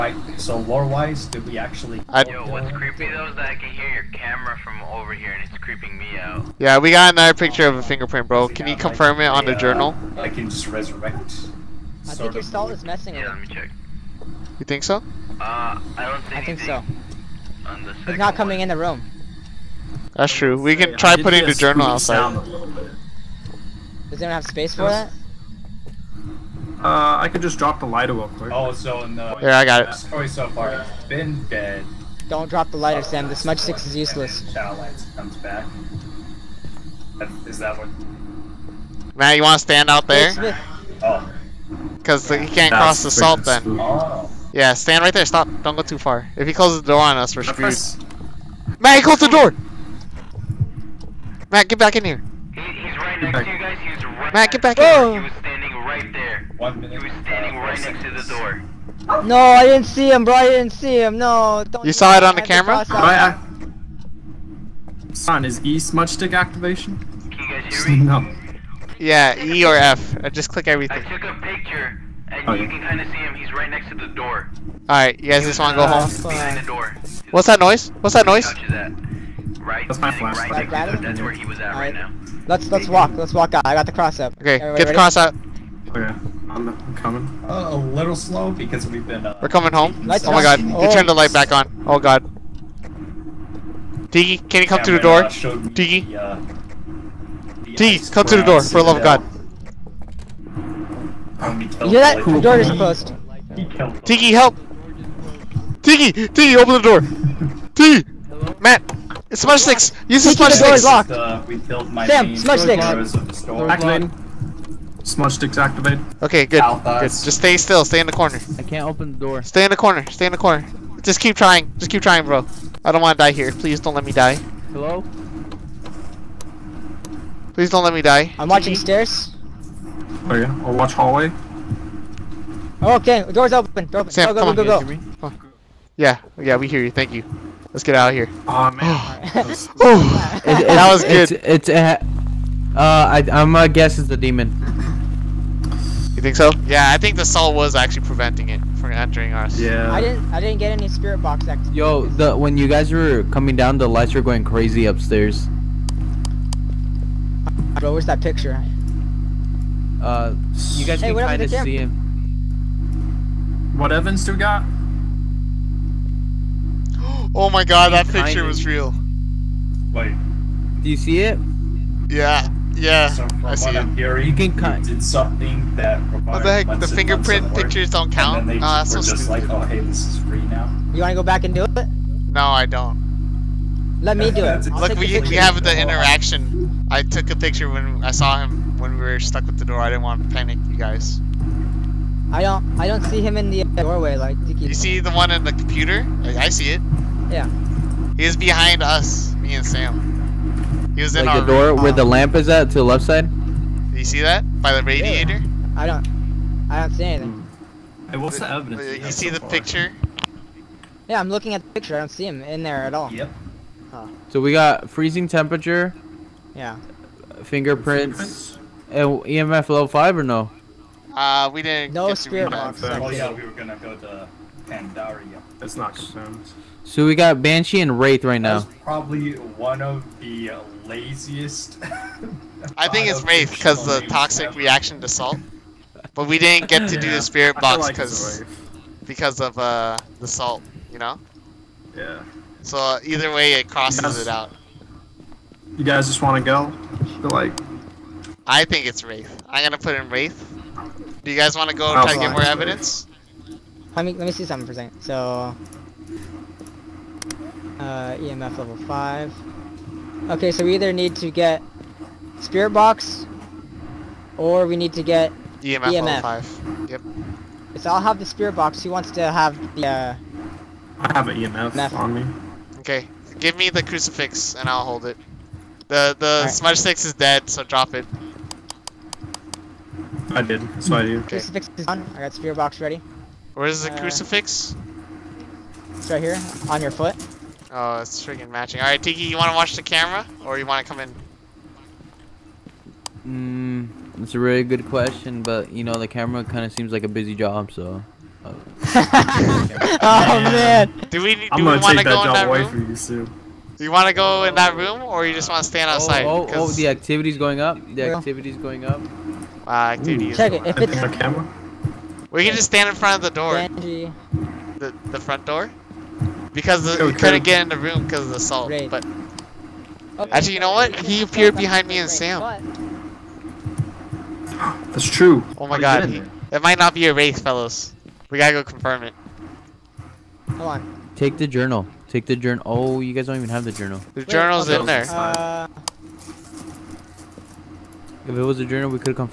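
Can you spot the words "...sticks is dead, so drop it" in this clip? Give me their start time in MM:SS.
04:36.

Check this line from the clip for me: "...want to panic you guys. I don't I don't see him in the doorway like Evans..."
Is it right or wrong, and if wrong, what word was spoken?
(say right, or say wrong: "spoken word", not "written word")
wrong: "You", not "Evans".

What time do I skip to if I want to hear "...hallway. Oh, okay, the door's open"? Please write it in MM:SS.
02:10.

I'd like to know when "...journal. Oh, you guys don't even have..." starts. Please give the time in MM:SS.
05:32.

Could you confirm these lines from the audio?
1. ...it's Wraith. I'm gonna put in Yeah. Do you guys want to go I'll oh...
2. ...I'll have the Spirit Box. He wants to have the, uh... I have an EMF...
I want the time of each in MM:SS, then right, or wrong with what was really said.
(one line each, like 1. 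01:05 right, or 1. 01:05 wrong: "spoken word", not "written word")
1. 04:08 wrong: "Wraith", not "Yeah"
2. 04:27 right.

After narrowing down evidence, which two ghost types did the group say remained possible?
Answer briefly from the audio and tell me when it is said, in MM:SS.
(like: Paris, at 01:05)
Banshee and Wraith, at 03:47.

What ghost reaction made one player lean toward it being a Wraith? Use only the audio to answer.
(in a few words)
reaction to salt.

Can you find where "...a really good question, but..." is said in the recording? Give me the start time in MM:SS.
04:54.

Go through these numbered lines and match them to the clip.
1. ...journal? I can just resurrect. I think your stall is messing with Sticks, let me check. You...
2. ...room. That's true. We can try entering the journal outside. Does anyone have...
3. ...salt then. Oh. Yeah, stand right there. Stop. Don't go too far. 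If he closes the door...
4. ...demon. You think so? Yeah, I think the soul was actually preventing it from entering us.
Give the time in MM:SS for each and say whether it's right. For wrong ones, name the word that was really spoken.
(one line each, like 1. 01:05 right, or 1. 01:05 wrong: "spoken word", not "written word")
1. 00:09 wrong: "Yeah", not "Sticks"
2. 00:18 wrong: "putting", not "entering"
3. 00:43 right
4. 02:24 right.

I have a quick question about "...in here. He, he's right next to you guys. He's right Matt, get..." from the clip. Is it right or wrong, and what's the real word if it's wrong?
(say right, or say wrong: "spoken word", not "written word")
right.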